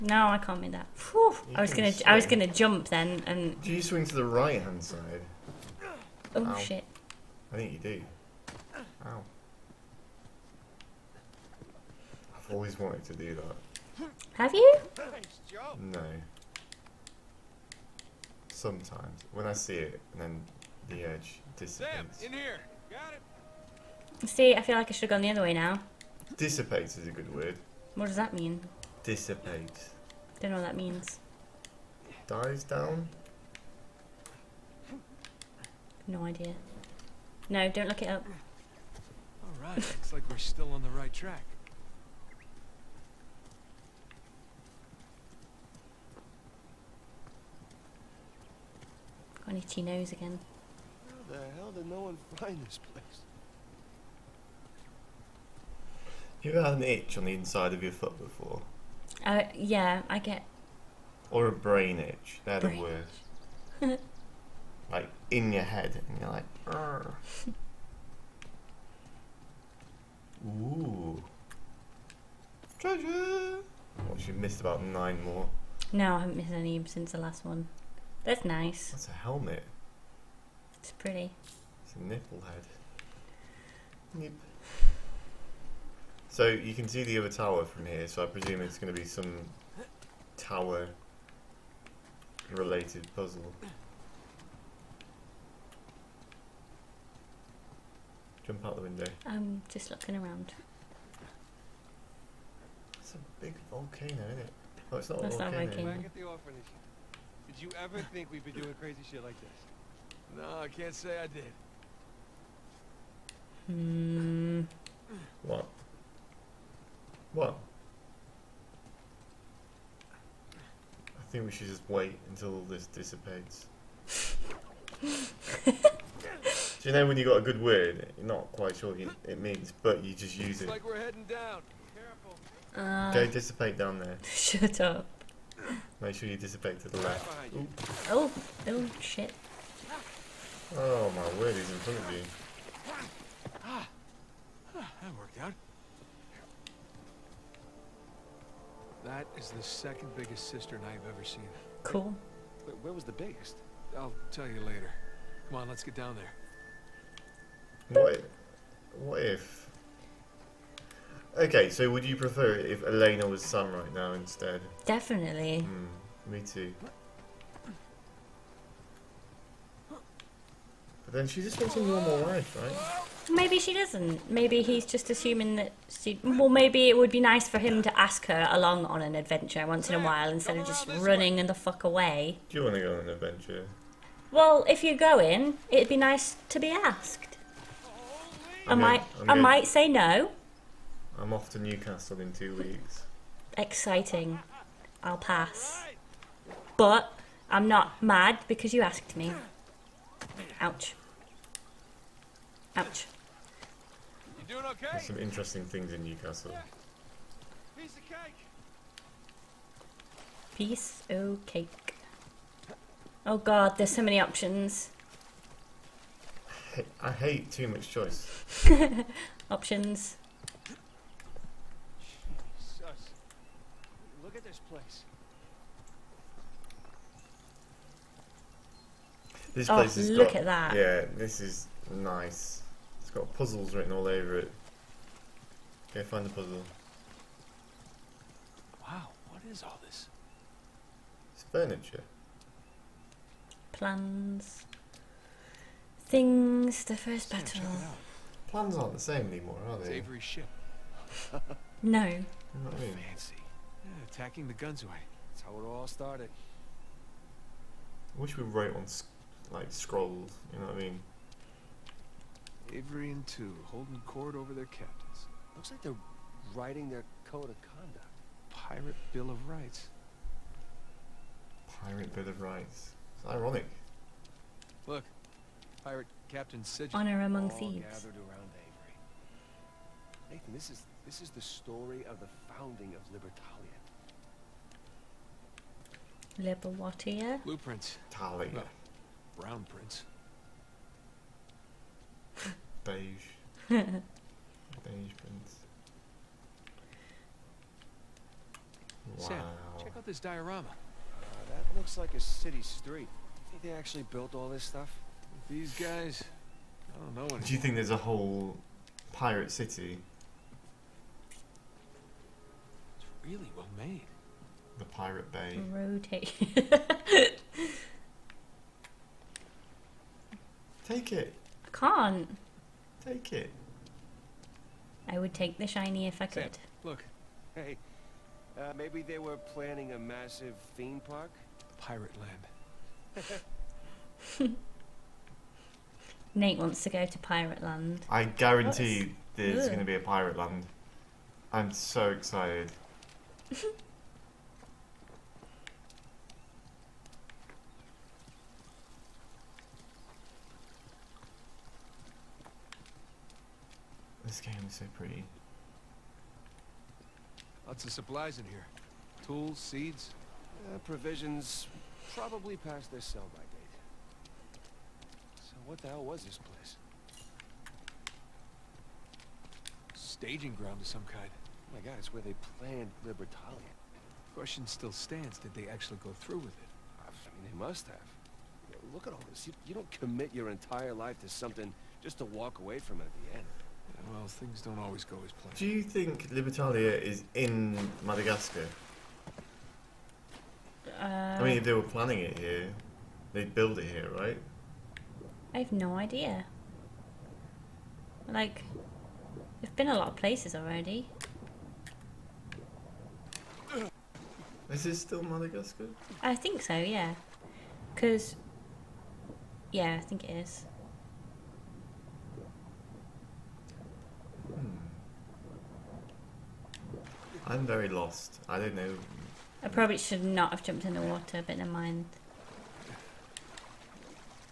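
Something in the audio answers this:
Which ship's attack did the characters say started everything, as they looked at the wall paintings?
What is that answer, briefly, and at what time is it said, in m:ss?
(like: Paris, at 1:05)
the Gunsway, at 4:14.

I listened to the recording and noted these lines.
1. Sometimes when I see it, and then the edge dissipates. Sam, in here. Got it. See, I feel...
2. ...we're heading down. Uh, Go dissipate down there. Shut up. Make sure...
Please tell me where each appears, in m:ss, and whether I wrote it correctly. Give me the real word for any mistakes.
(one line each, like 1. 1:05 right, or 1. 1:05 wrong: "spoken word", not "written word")
1. 0:18 right
2. 2:10 right.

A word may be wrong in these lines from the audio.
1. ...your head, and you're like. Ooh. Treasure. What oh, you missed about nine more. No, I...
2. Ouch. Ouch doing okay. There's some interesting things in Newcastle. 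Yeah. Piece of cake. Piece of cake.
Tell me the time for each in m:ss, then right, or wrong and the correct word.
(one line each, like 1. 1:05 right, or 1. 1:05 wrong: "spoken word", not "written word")
1. 1:05 right
2. 3:20 right.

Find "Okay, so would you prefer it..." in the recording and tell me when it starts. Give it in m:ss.
2:41.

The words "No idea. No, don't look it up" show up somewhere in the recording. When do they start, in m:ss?
0:36.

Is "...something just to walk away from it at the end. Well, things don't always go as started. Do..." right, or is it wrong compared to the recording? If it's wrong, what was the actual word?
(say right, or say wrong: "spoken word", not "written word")
wrong: "planned", not "started".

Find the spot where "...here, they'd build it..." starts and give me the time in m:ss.
6:32.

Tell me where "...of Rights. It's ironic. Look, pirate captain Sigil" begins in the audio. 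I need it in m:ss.
4:32.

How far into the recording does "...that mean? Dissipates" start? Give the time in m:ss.
0:28.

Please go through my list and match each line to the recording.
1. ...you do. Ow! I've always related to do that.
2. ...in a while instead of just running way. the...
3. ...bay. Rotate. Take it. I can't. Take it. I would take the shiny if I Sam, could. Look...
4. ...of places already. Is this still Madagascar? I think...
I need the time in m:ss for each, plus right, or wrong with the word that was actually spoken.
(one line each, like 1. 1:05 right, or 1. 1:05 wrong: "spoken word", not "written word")
1. 0:07 wrong: "wanted", not "related"
2. 2:59 right
3. 5:15 right
4. 6:40 right.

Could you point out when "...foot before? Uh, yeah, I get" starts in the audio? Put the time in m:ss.
0:57.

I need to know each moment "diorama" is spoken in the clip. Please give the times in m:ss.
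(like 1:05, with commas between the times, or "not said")
5:00.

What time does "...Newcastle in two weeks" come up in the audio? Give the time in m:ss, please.
3:11.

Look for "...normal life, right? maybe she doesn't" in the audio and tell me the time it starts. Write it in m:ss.
2:51.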